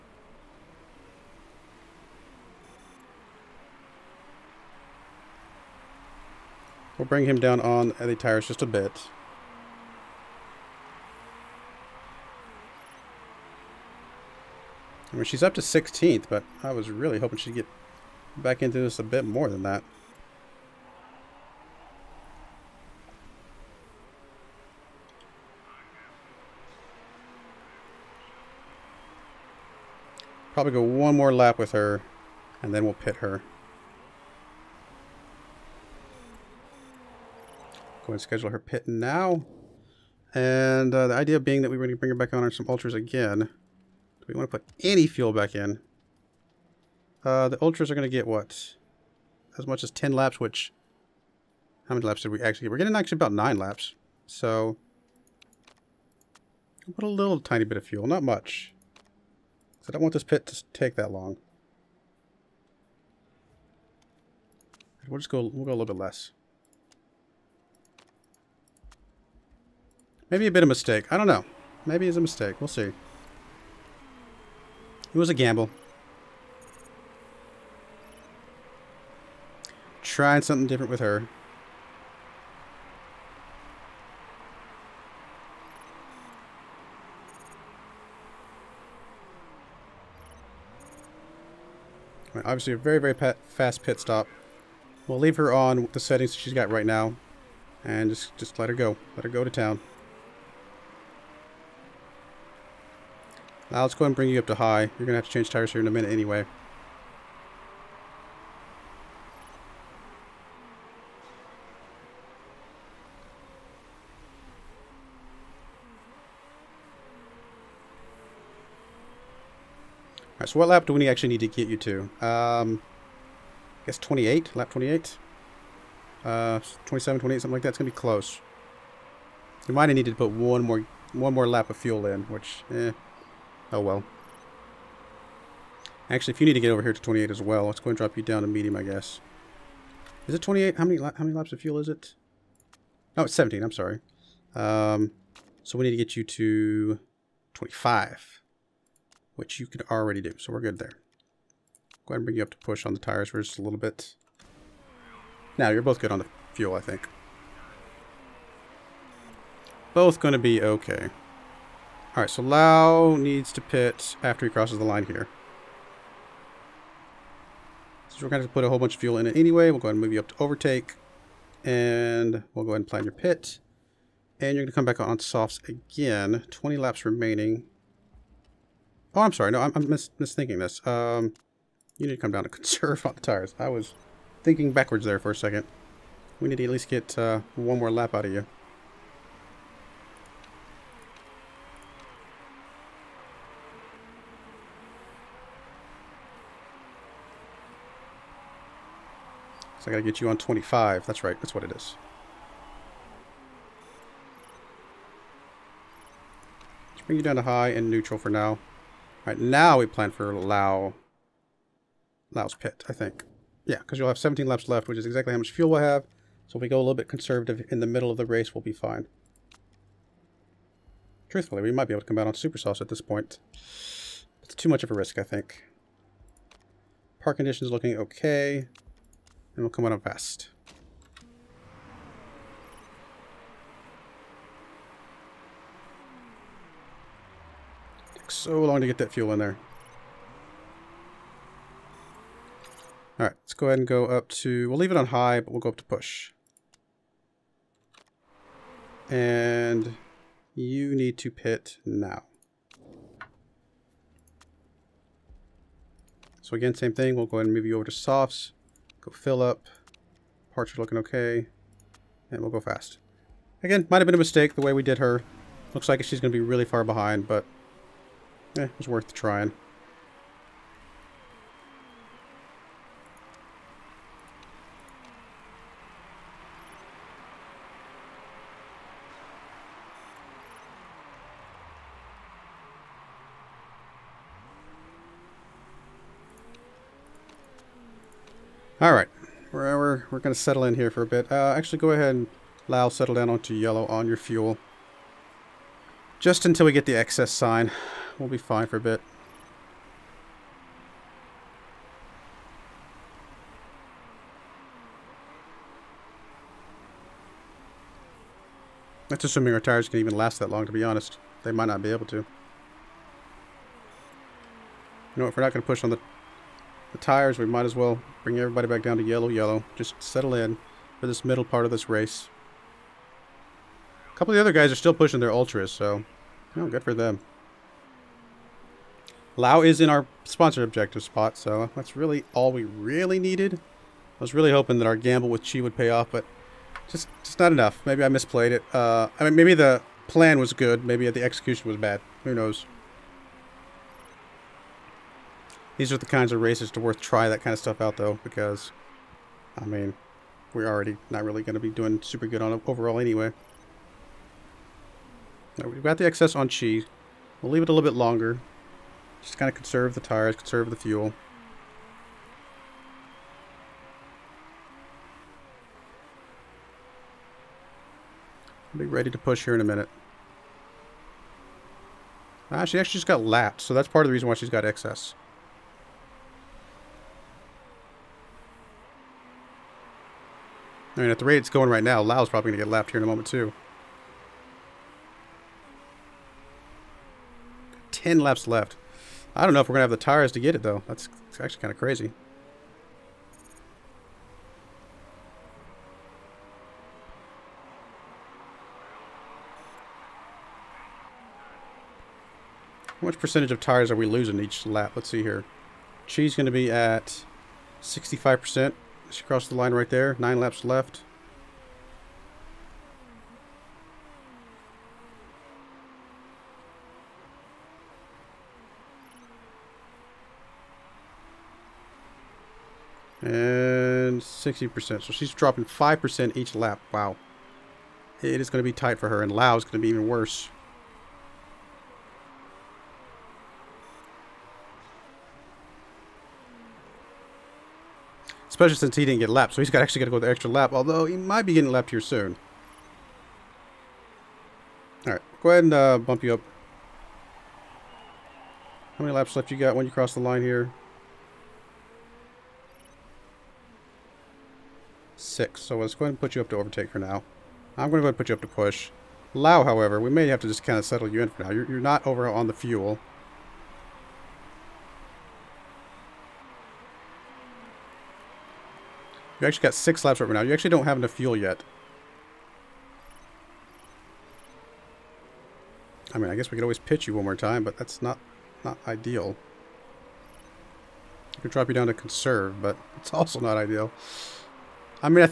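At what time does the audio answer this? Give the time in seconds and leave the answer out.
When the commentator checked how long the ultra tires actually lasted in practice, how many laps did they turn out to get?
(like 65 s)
53 s.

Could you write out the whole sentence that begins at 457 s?
I'm going to go ahead and put you up to push.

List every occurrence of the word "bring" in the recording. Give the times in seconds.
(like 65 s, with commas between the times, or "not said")
7 s, 41 s, 104 s, 152 s, 207 s, 318 s.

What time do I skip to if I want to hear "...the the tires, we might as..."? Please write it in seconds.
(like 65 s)
315 s.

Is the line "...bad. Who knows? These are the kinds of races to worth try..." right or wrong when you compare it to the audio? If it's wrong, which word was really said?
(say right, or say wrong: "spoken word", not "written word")
right.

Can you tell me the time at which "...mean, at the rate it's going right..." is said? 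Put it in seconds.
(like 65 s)
380 s.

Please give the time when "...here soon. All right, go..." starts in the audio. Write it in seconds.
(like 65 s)
441 s.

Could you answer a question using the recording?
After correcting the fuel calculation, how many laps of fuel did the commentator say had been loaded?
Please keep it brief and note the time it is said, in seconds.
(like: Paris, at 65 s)
17, at 143 s.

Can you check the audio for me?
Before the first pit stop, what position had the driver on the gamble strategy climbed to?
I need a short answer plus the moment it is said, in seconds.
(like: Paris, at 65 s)
16th, at 15 s.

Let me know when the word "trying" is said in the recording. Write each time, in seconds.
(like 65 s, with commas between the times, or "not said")
80 s, 269 s.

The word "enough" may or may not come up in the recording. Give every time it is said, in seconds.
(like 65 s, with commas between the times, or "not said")
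337 s, 470 s.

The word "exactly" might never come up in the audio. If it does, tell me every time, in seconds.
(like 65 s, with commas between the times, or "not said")
215 s.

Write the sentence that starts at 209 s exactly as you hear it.
Alright, now we plan for Lau...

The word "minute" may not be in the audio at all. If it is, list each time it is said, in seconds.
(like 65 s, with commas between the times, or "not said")
105 s, 369 s.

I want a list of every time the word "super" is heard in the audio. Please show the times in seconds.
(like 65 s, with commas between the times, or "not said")
222 s, 352 s.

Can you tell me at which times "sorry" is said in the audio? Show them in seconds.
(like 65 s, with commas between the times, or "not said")
143 s, 179 s.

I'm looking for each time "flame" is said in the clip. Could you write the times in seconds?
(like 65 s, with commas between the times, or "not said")
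not said.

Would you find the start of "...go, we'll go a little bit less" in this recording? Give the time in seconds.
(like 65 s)
65 s.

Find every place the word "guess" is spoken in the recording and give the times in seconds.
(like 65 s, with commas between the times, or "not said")
123 s, 138 s, 476 s.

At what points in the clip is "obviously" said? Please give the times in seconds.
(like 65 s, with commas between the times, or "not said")
92 s.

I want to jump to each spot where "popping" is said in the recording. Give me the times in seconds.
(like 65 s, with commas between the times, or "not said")
not said.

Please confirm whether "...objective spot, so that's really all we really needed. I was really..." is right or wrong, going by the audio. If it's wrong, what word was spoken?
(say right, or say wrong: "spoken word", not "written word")
right.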